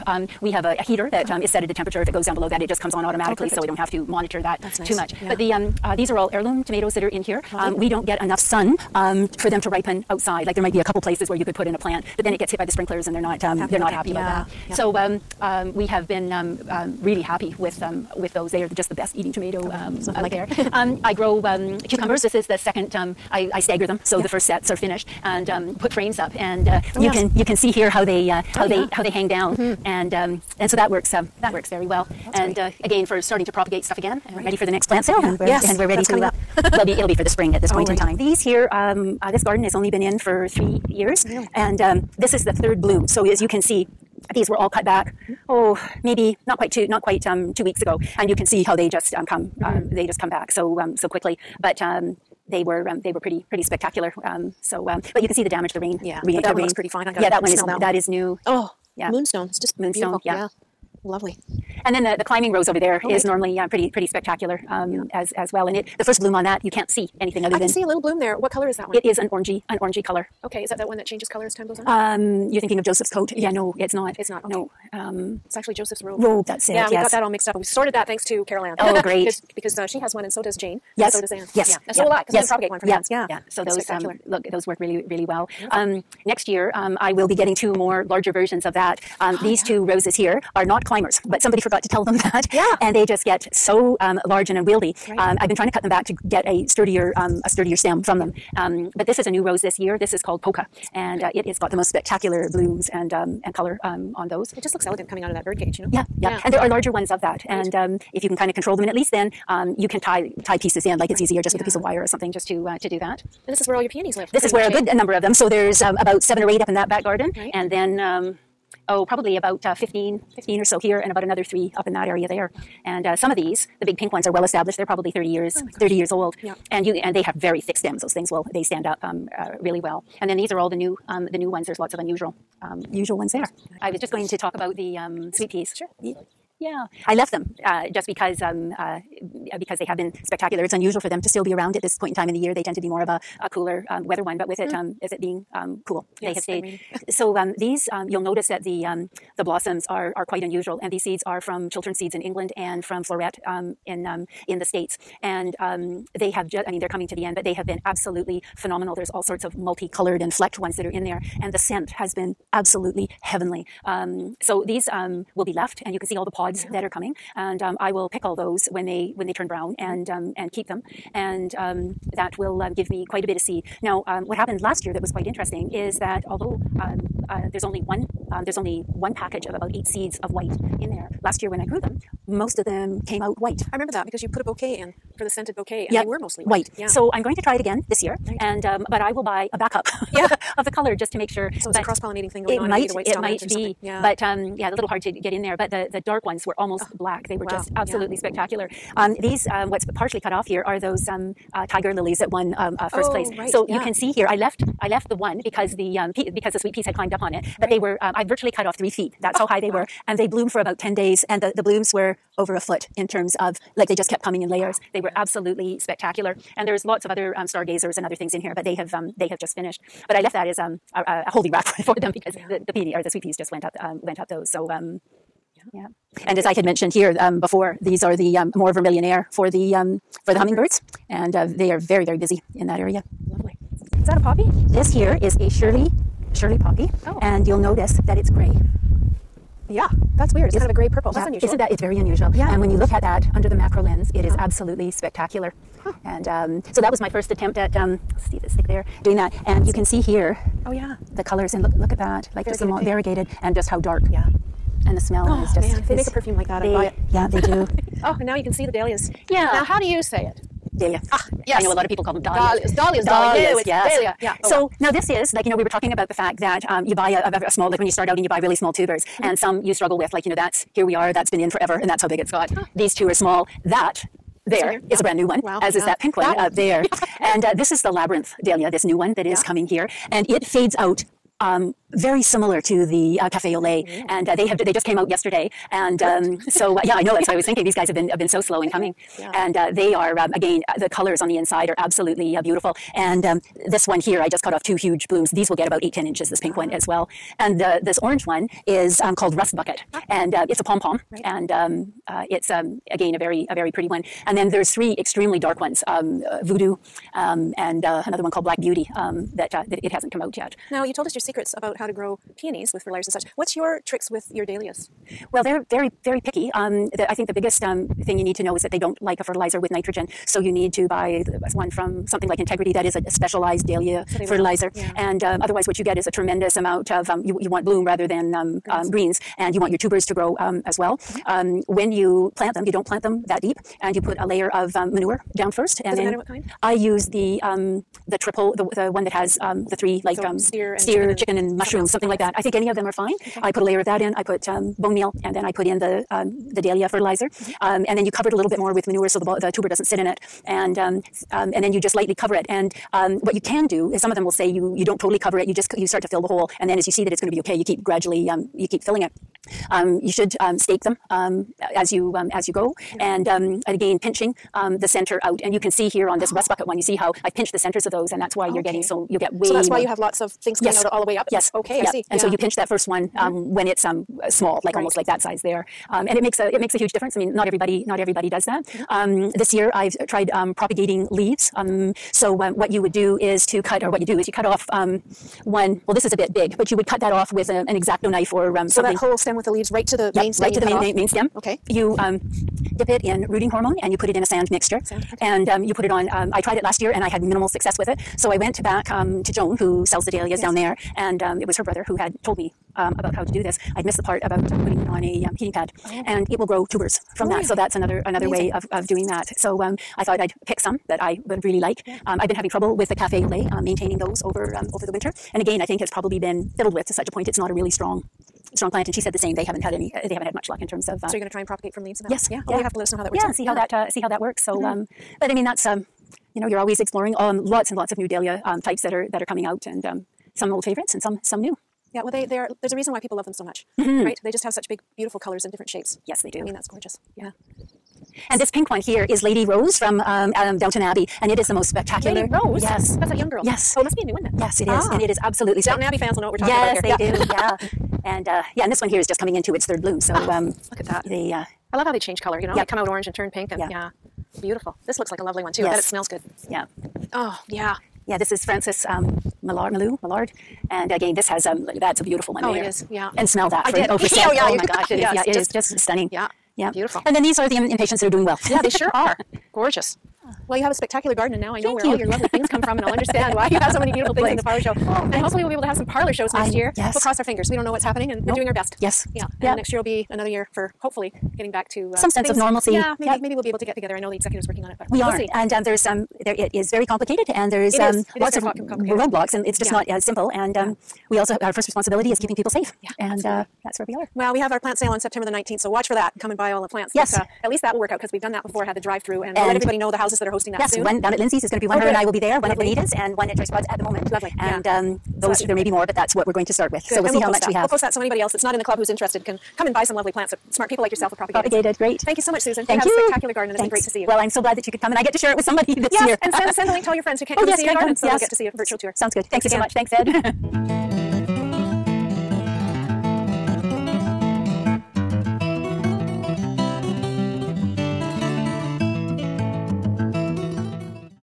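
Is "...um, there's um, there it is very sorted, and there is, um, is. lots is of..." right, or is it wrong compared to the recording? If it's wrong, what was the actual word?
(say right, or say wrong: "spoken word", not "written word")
wrong: "complicated", not "sorted".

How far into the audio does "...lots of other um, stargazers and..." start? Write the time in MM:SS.
03:36.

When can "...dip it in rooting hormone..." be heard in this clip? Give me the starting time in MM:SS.
06:32.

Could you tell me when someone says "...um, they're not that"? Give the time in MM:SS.
00:13.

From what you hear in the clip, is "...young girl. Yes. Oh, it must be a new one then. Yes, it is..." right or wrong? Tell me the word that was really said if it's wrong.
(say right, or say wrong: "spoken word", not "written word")
right.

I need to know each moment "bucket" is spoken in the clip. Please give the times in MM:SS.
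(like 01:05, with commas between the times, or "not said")
04:59, 06:06.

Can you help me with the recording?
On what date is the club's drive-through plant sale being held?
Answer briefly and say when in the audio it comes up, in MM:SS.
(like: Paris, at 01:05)
September 19, at 08:14.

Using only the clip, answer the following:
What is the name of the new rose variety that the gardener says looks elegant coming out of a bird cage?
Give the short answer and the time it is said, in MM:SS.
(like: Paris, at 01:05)
Polka, at 01:39.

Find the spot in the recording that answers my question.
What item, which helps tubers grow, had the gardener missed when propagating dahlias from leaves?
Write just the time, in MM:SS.
06:45.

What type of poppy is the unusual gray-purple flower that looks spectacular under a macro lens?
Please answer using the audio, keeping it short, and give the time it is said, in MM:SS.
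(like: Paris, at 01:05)
Shirley poppy, at 03:56.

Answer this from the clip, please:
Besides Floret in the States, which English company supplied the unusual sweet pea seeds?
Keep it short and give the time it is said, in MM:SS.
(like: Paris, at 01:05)
Chiltern seeds, at 02:31.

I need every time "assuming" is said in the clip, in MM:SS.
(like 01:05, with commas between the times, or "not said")
not said.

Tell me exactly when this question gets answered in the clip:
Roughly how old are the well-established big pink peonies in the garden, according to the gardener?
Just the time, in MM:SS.
02:05.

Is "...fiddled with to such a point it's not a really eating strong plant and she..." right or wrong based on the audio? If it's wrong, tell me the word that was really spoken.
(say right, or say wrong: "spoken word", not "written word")
wrong: "strong", not "eating".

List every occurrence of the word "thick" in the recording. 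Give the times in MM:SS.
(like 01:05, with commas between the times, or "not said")
02:07, 04:08.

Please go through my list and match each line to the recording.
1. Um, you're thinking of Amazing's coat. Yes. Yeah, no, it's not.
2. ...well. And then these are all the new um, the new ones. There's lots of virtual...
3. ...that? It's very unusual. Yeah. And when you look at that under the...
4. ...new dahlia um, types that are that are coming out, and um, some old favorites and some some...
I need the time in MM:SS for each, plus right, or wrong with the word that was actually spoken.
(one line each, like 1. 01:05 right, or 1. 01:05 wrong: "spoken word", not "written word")
1. 01:11 wrong: "Joseph", not "Amazing"
2. 02:09 wrong: "unusual", not "virtual"
3. 04:01 right
4. 07:07 right.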